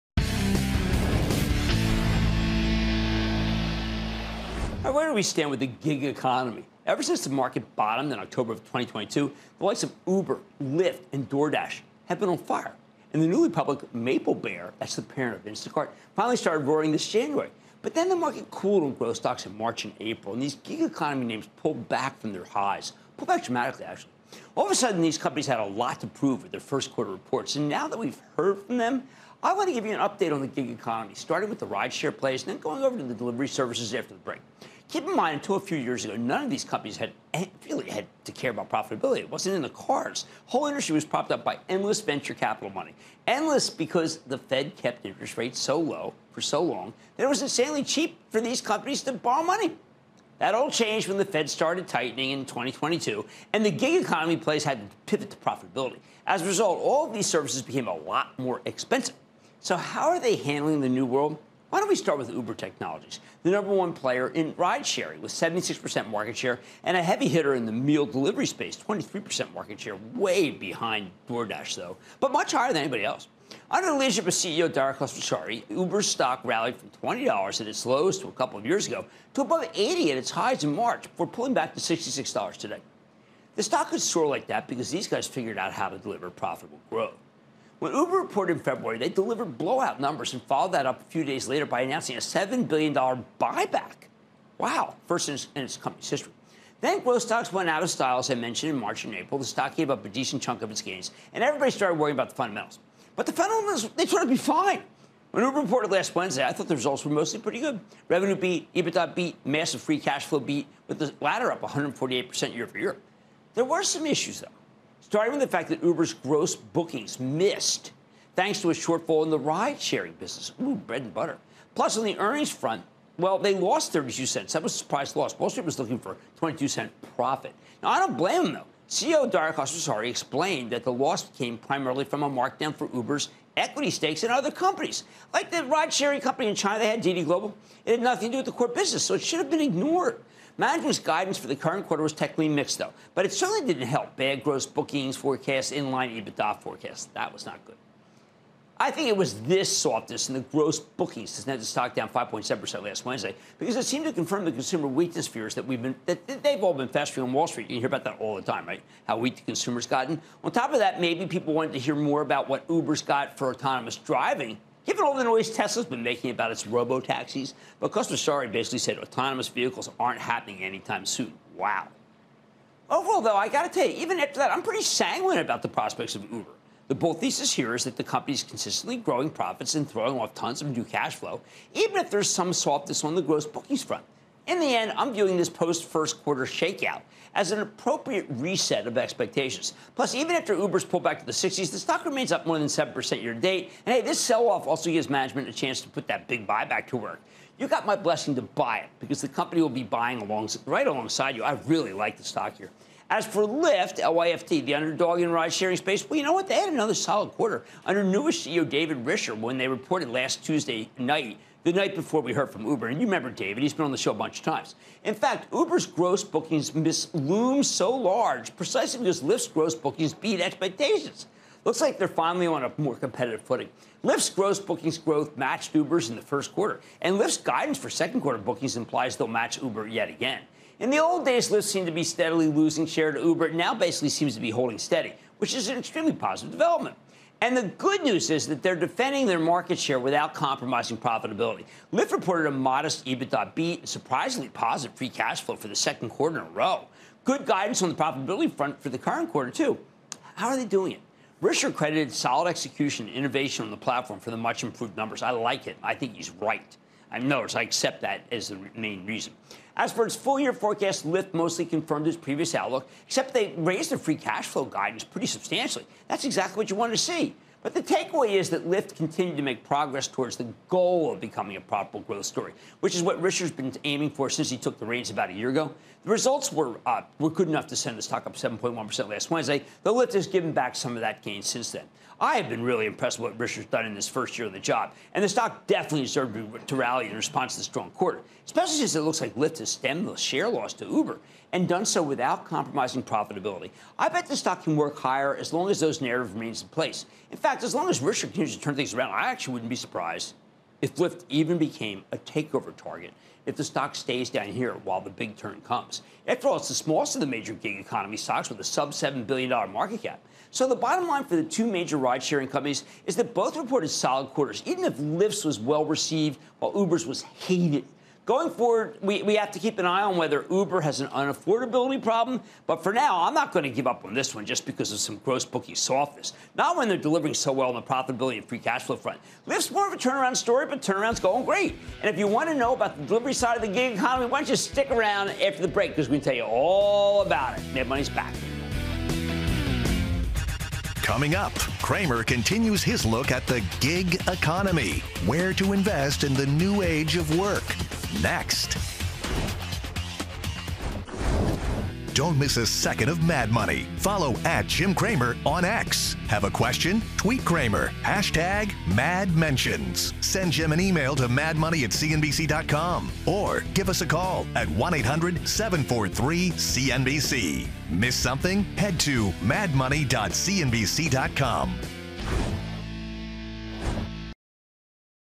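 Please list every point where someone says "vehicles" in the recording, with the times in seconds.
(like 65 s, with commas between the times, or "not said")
169 s.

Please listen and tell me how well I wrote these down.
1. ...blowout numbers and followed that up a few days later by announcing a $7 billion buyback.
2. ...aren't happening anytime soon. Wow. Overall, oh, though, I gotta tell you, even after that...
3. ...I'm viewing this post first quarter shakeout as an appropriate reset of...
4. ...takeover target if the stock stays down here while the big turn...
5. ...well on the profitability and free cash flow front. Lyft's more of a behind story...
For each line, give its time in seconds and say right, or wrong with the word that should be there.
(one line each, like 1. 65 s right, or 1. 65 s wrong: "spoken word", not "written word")
1. 89 s right
2. 169 s right
3. 184 s right
4. 302 s right
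5. 327 s wrong: "turnaround", not "behind".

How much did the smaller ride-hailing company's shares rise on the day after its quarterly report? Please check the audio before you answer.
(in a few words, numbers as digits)
7.1%.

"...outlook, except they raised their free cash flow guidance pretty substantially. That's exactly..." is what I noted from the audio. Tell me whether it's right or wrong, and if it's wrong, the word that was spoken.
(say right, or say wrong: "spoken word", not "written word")
right.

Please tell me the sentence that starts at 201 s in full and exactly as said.
I really like the stock here.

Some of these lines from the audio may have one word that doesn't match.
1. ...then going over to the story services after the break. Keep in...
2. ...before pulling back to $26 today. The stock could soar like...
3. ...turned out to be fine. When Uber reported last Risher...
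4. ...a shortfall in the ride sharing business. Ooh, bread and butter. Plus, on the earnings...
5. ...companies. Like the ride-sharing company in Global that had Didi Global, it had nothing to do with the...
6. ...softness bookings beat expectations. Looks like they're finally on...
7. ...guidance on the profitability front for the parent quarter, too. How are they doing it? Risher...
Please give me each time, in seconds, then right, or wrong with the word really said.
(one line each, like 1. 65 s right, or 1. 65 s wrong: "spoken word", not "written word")
1. 32 s wrong: "delivery", not "story"
2. 81 s wrong: "66", not "26"
3. 104 s wrong: "Wednesday", not "Risher"
4. 118 s right
5. 134 s wrong: "China", not "Global"
6. 219 s wrong: "gross", not "softness"
7. 247 s wrong: "current", not "parent".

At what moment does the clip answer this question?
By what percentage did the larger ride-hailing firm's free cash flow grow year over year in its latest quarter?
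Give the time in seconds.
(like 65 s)
111 s.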